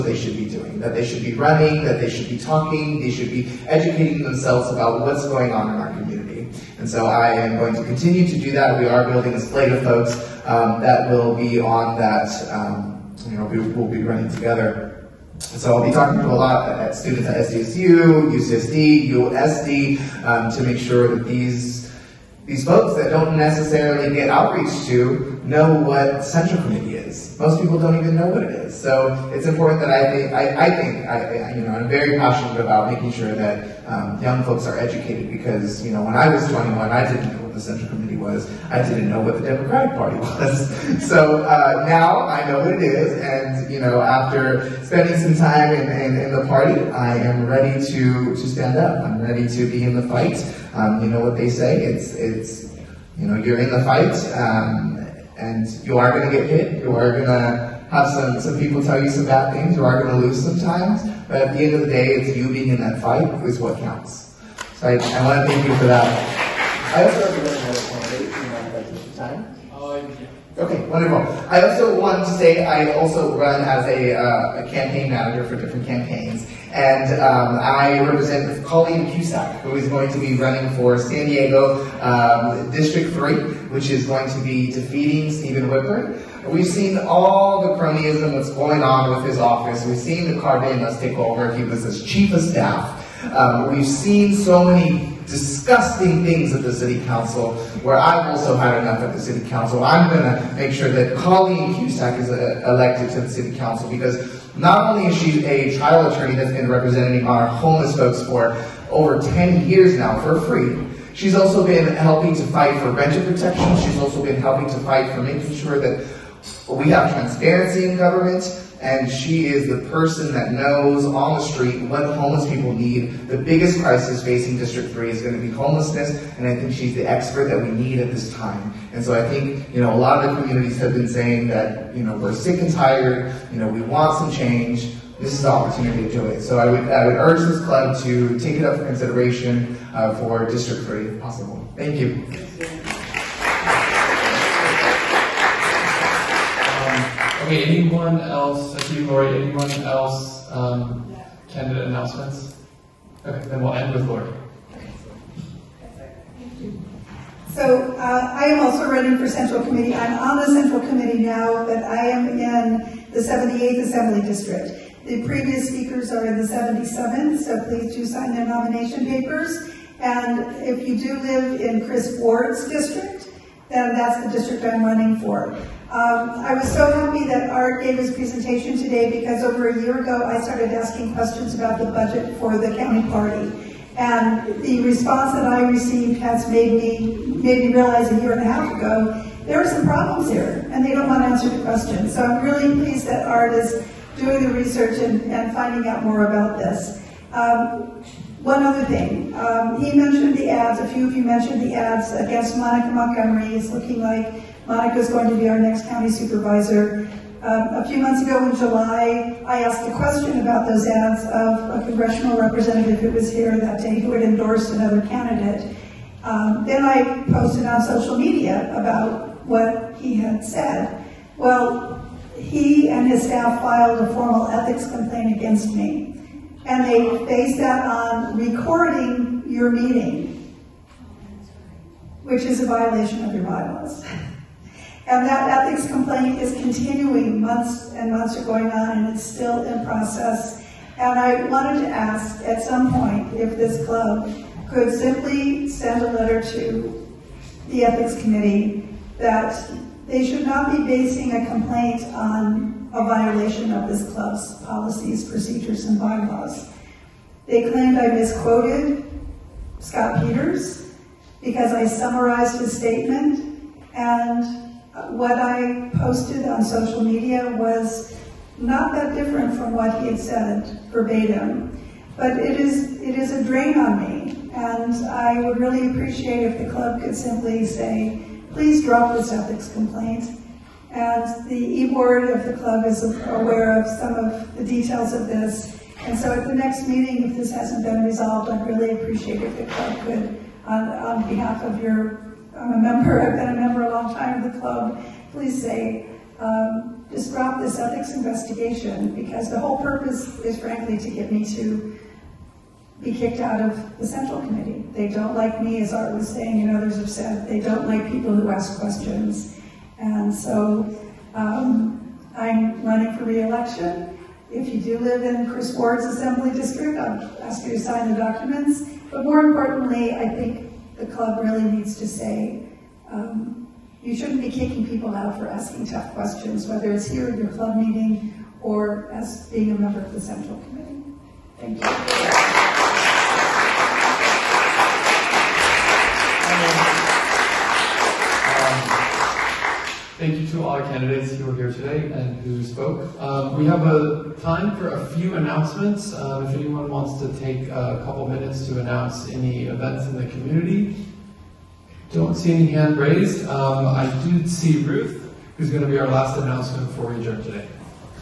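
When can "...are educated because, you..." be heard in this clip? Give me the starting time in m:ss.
0:34.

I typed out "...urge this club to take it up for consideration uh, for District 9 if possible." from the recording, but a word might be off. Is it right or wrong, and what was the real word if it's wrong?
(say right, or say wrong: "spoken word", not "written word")
wrong: "3", not "9".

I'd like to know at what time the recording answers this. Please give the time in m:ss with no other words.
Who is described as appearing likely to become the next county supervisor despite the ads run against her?
3:22.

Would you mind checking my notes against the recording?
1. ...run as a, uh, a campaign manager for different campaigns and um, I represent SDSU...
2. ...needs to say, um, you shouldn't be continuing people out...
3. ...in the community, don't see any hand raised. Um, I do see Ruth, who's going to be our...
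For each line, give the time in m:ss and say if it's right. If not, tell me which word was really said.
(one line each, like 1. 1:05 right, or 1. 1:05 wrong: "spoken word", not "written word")
1. 1:13 wrong: "Colleen", not "SDSU"
2. 5:21 wrong: "kicking", not "continuing"
3. 5:50 right.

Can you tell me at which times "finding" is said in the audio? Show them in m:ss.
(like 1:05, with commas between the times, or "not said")
3:15.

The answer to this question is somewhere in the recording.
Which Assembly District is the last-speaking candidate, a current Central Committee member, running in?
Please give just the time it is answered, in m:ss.
2:43.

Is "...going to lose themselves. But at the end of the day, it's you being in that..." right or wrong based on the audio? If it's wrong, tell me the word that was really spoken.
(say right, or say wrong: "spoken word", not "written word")
wrong: "sometimes", not "themselves".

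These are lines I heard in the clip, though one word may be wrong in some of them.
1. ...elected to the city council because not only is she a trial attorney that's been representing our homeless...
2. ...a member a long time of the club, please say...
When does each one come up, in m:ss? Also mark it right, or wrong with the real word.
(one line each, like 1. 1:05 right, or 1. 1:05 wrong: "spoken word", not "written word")
1. 1:42 right
2. 4:53 right.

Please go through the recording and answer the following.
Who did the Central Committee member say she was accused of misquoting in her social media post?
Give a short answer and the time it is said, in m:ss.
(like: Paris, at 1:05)
Scott Peters, at 4:19.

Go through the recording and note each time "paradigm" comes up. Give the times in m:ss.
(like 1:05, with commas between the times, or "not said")
not said.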